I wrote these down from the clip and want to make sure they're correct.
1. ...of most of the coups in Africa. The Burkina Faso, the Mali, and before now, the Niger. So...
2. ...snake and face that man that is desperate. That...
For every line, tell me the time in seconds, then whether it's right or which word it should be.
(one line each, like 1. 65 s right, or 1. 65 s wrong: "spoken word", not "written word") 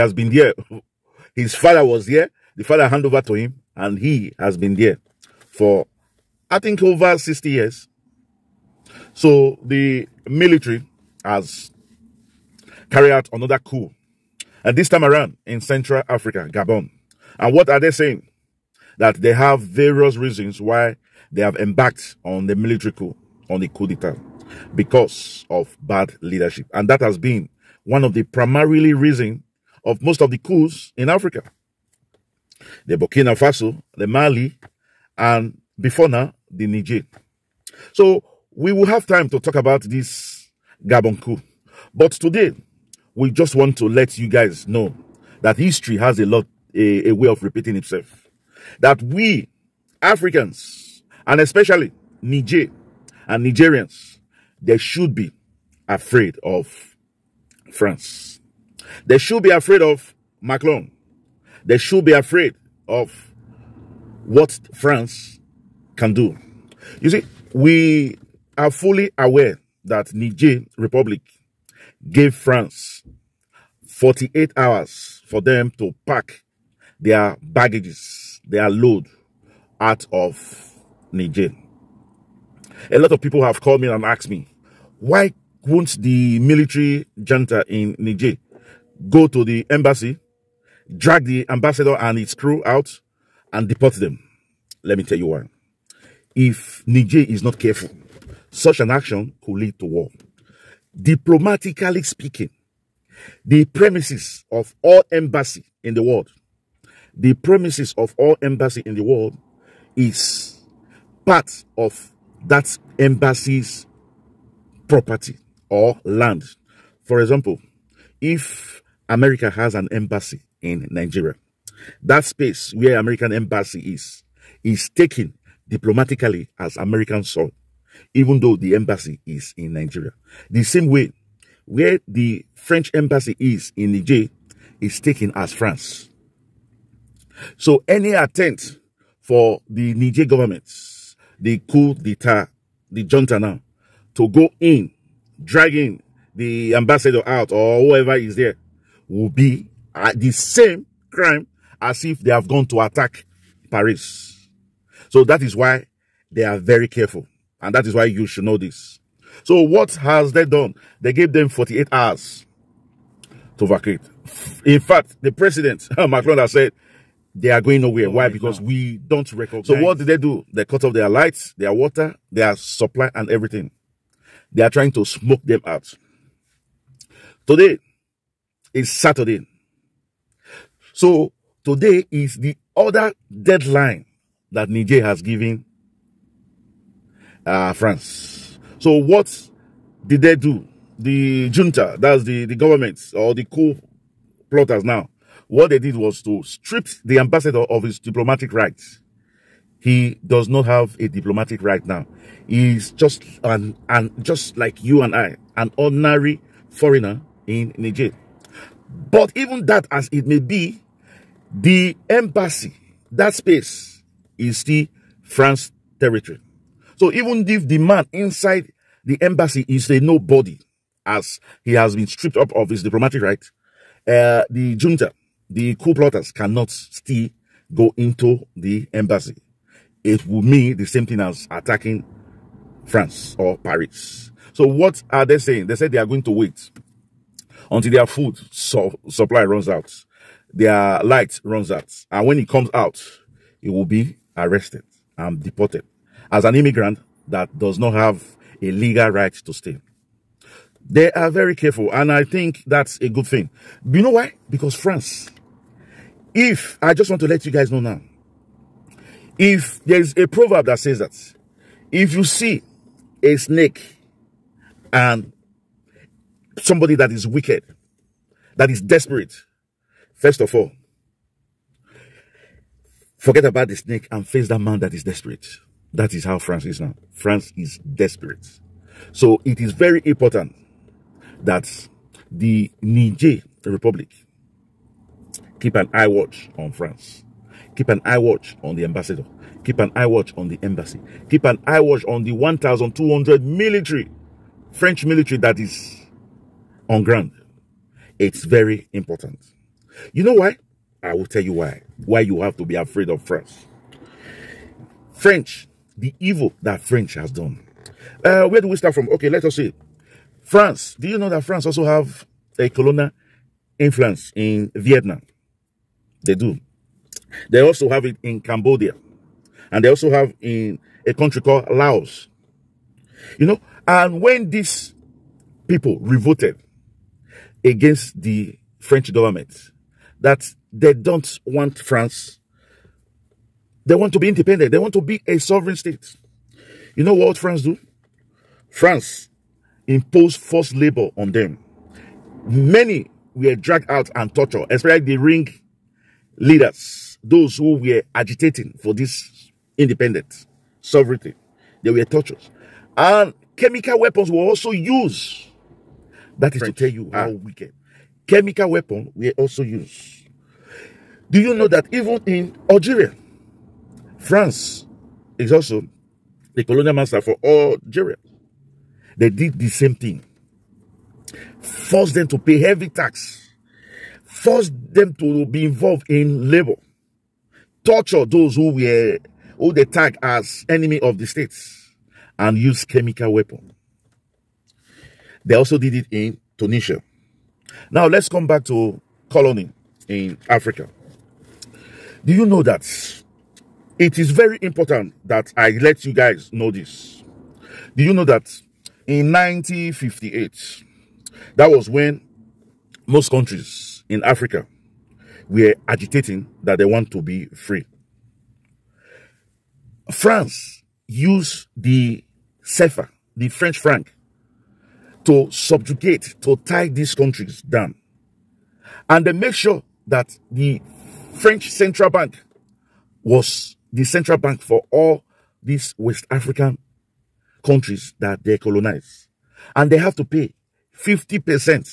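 1. 29 s right
2. 273 s right.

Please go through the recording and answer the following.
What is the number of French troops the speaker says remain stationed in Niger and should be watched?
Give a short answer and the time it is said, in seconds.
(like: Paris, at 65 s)
1,200, at 292 s.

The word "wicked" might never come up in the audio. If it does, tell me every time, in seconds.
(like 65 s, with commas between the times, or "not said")
267 s, 357 s.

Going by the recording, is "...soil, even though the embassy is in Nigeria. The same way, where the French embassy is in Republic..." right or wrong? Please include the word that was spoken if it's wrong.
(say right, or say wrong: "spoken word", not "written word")
wrong: "Niger", not "Republic".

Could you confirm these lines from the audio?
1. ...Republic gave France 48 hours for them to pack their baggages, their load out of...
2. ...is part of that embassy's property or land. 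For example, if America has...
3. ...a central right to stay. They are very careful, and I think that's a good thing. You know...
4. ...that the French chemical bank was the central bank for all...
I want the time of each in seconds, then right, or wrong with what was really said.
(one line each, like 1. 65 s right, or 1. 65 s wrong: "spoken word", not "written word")
1. 70 s right
2. 109 s right
3. 248 s wrong: "legal", not "central"
4. 420 s wrong: "central", not "chemical".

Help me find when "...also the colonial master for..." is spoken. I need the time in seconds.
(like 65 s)
365 s.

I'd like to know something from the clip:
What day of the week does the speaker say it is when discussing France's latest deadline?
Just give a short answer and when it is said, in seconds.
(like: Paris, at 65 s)
Saturday, at 178 s.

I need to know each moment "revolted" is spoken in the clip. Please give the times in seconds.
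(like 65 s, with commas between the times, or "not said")
326 s.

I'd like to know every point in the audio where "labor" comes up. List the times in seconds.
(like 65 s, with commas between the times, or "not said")
340 s, 376 s.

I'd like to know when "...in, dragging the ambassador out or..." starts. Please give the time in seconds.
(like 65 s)
144 s.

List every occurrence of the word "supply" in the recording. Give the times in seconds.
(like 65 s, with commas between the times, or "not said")
172 s, 239 s.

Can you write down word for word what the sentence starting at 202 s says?
He's just an, an just like you and I, an ordinary foreigner in Niger.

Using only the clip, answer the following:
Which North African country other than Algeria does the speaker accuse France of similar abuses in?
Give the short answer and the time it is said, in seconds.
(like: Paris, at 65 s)
Tunisia, at 386 s.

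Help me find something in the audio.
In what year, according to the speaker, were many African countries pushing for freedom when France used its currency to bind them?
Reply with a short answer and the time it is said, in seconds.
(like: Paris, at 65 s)
1958, at 399 s.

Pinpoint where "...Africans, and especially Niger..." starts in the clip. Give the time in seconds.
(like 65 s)
50 s.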